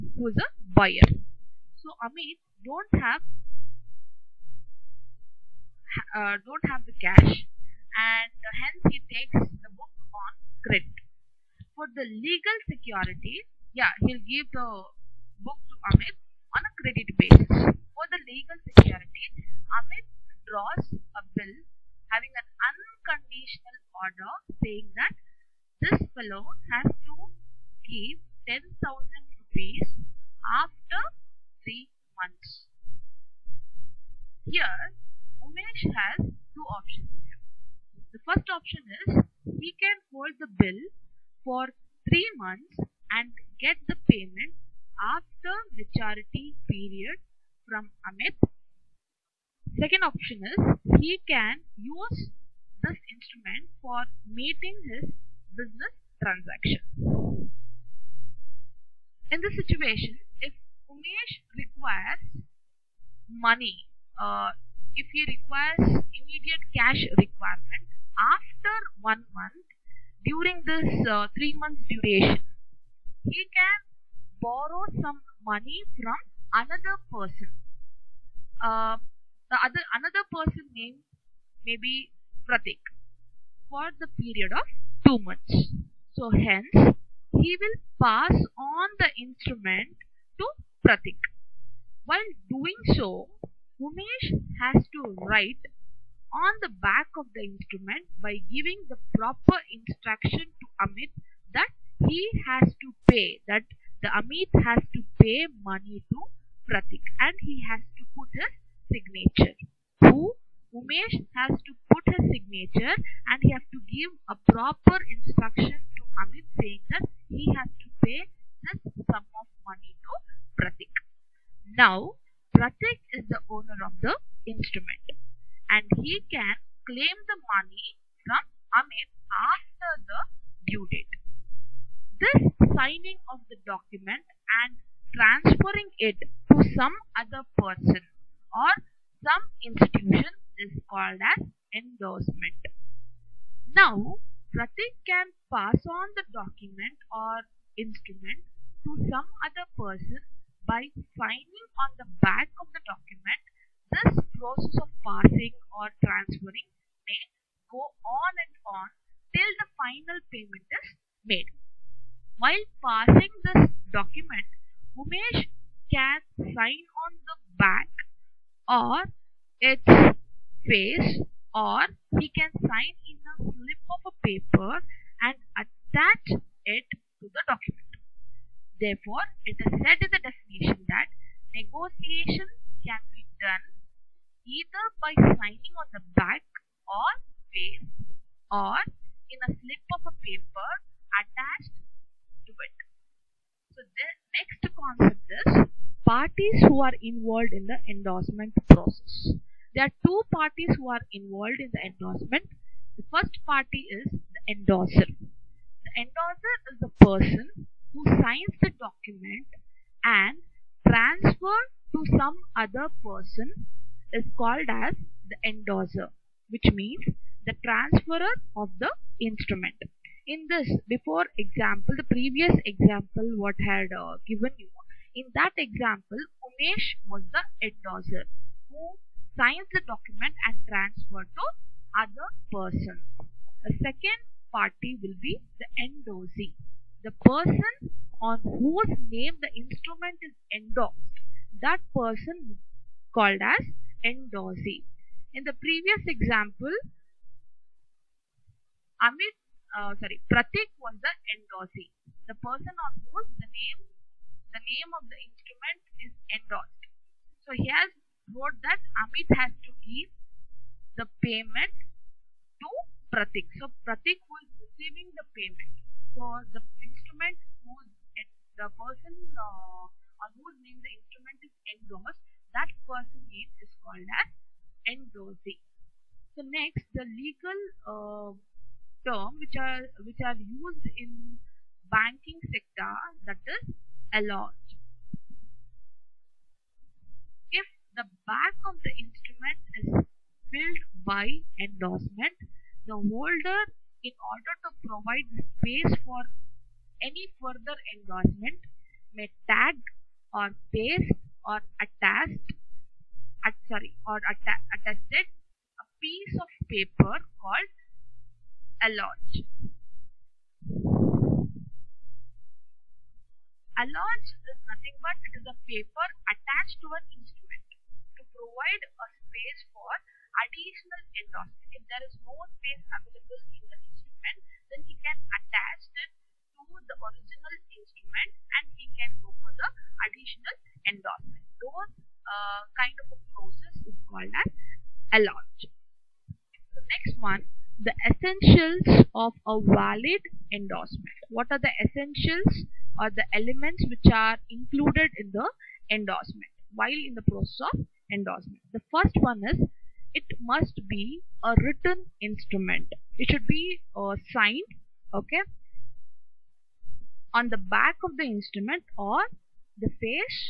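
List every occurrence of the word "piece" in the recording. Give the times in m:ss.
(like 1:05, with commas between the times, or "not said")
5:05.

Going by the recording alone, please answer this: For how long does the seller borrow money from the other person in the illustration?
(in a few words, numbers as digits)
two months.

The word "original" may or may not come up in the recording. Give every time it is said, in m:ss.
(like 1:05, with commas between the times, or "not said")
5:26.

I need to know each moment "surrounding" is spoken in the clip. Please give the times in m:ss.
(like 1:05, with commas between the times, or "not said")
not said.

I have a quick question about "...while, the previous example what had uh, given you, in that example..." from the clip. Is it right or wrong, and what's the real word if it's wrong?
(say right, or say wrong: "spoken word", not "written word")
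wrong: "example", not "while".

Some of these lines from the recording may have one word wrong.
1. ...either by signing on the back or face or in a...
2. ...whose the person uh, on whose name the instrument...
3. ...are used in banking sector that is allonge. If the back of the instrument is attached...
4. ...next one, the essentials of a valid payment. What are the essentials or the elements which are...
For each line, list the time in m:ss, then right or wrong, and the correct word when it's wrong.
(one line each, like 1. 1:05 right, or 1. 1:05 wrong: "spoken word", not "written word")
1. 3:04 right
2. 4:27 right
3. 4:40 wrong: "filled", not "attached"
4. 5:36 wrong: "endorsement", not "payment".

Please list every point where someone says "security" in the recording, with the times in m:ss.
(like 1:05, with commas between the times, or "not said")
0:12, 0:18.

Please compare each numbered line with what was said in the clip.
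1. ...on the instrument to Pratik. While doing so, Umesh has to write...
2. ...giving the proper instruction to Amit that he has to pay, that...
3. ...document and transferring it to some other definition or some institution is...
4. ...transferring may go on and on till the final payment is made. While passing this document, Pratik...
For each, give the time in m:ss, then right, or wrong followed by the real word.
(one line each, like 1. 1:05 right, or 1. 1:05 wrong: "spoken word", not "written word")
1. 1:28 right
2. 1:38 right
3. 2:13 wrong: "person", not "definition"
4. 2:36 wrong: "Umesh", not "Pratik".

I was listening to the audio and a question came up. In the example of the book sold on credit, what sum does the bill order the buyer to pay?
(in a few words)
10,000 rupees.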